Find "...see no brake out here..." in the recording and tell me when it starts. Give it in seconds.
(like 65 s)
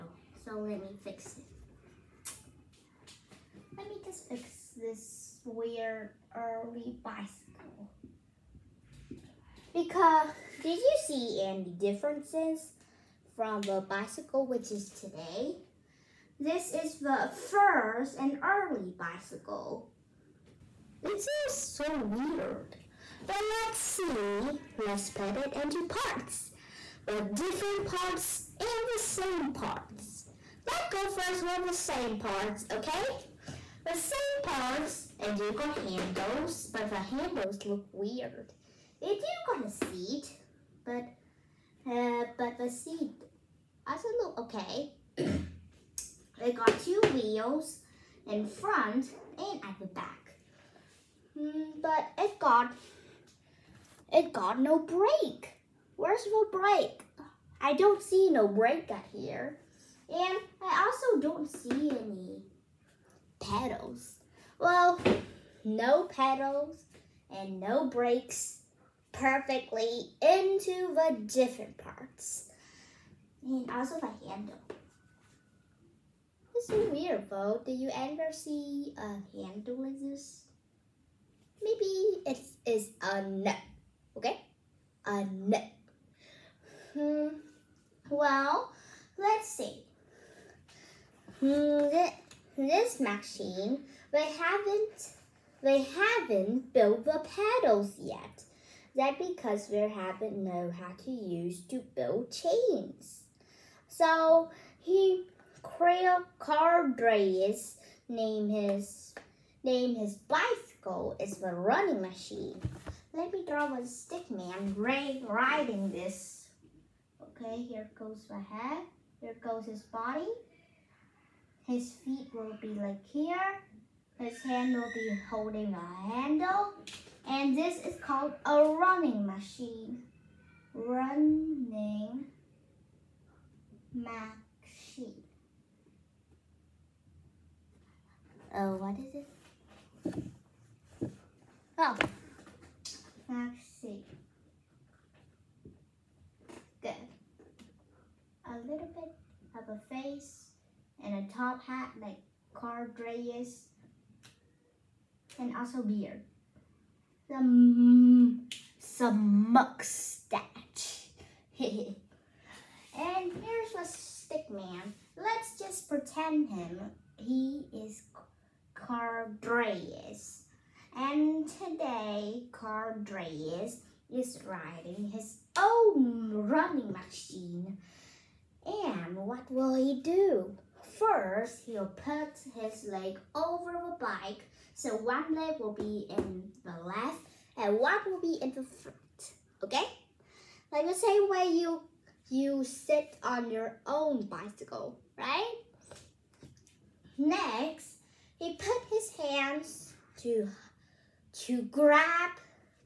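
58 s.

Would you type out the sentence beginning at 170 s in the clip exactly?
And today, Cardreas is riding his own running machine.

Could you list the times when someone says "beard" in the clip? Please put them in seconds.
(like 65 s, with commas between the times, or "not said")
155 s.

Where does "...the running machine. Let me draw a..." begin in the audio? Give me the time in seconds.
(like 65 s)
111 s.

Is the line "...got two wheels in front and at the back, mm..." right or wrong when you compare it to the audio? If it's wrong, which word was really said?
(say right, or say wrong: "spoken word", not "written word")
right.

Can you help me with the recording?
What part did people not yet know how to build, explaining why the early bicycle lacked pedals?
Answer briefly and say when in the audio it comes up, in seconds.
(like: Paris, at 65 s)
chains, at 102 s.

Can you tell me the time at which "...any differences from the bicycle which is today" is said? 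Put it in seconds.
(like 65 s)
11 s.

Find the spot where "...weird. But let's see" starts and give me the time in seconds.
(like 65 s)
22 s.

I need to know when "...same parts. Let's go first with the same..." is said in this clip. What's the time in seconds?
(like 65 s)
28 s.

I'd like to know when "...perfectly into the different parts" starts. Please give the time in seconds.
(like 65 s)
69 s.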